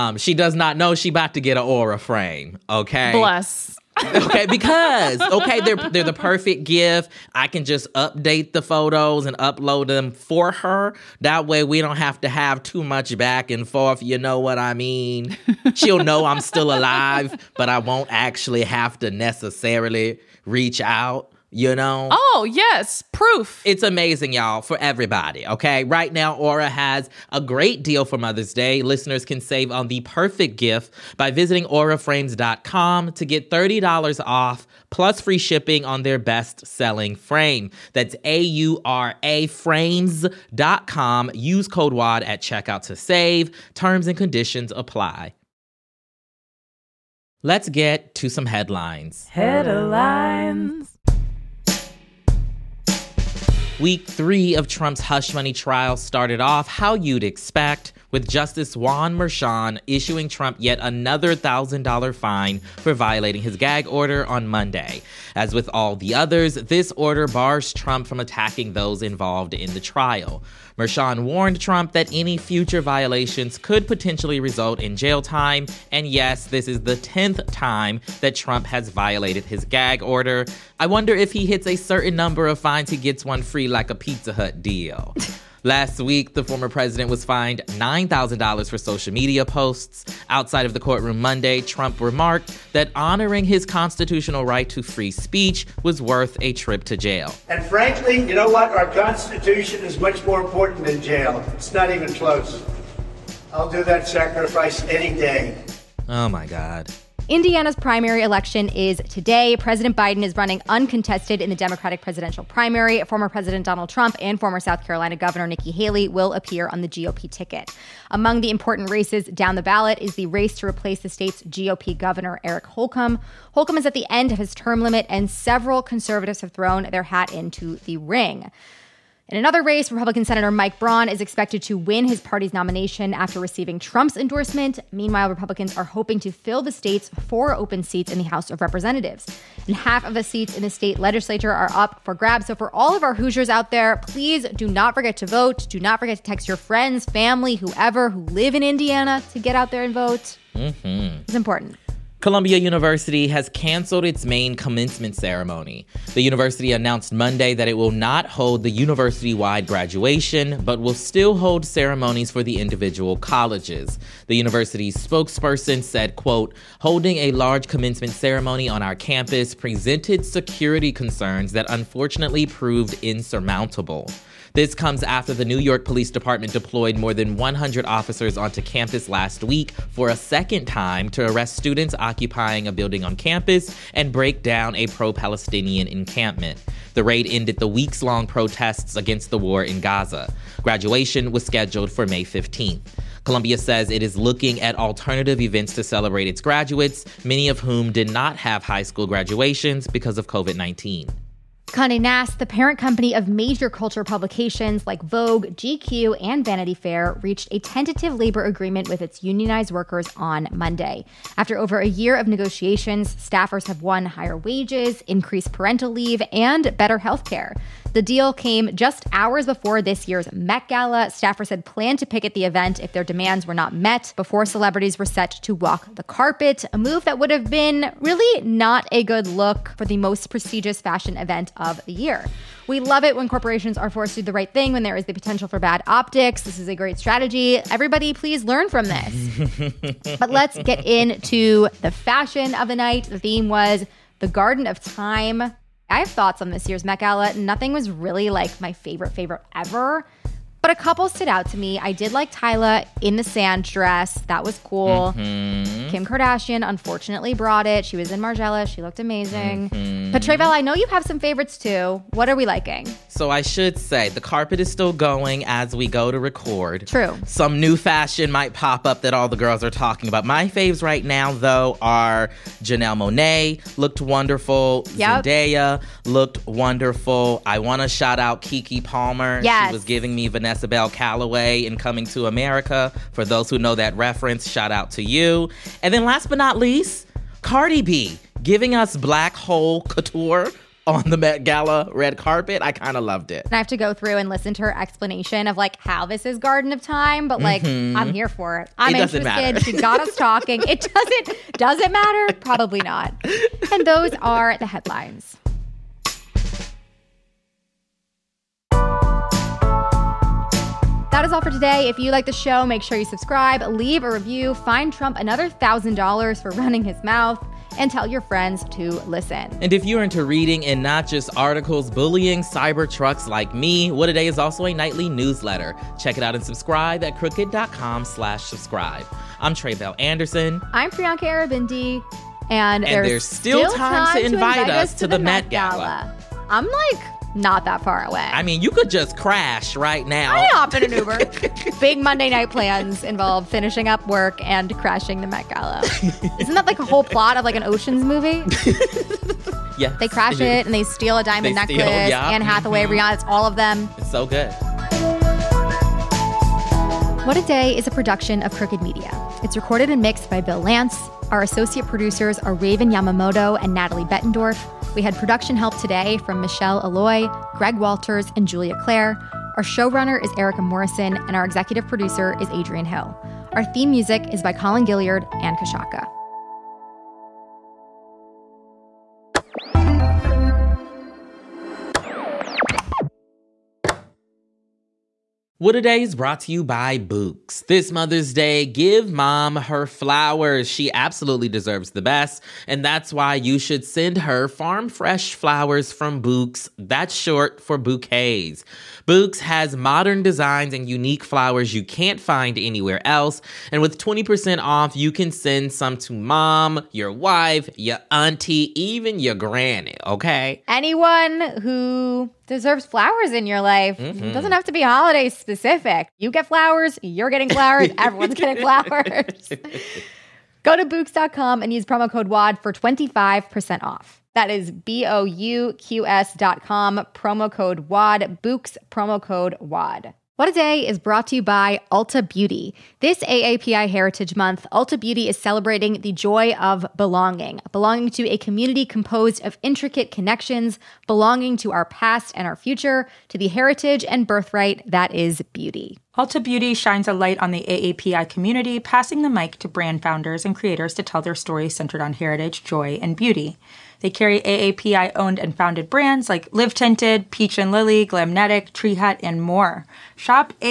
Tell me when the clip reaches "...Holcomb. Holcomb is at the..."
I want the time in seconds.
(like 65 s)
122 s.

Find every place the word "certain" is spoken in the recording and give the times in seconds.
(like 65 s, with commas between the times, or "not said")
81 s.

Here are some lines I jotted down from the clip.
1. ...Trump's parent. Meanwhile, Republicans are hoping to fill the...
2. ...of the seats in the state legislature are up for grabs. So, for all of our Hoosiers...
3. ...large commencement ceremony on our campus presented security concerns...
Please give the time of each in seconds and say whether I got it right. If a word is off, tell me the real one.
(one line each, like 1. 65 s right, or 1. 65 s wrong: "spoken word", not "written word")
1. 133 s wrong: "endorsement", not "parent"
2. 140 s right
3. 167 s right.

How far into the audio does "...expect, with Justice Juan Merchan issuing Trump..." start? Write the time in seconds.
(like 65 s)
57 s.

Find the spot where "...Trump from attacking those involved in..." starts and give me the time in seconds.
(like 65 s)
67 s.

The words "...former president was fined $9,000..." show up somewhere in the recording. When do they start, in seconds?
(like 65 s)
86 s.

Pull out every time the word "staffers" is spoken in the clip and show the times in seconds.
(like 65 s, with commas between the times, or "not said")
213 s, 221 s.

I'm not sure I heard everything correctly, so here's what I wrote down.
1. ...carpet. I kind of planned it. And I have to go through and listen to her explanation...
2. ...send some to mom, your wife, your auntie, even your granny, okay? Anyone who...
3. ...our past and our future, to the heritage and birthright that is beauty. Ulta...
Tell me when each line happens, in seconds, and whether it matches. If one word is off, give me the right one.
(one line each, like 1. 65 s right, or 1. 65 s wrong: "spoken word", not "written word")
1. 292 s wrong: "loved", not "planned"
2. 405 s right
3. 441 s right.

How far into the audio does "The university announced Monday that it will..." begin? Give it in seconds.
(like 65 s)
156 s.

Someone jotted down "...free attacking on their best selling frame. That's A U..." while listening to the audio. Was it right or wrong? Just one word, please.
wrong.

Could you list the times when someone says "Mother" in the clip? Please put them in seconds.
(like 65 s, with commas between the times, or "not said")
28 s, 387 s.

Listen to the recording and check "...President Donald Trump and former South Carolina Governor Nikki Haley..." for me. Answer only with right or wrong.
right.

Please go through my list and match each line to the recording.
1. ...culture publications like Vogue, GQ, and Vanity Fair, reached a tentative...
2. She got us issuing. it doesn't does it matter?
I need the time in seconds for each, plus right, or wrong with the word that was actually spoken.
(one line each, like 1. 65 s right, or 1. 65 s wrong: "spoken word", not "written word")
1. 203 s right
2. 299 s wrong: "talking", not "issuing".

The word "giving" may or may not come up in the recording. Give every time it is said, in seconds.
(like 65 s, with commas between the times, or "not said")
279 s, 288 s.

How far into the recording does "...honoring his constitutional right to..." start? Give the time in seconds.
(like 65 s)
92 s.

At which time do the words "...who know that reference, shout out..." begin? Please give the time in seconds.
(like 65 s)
283 s.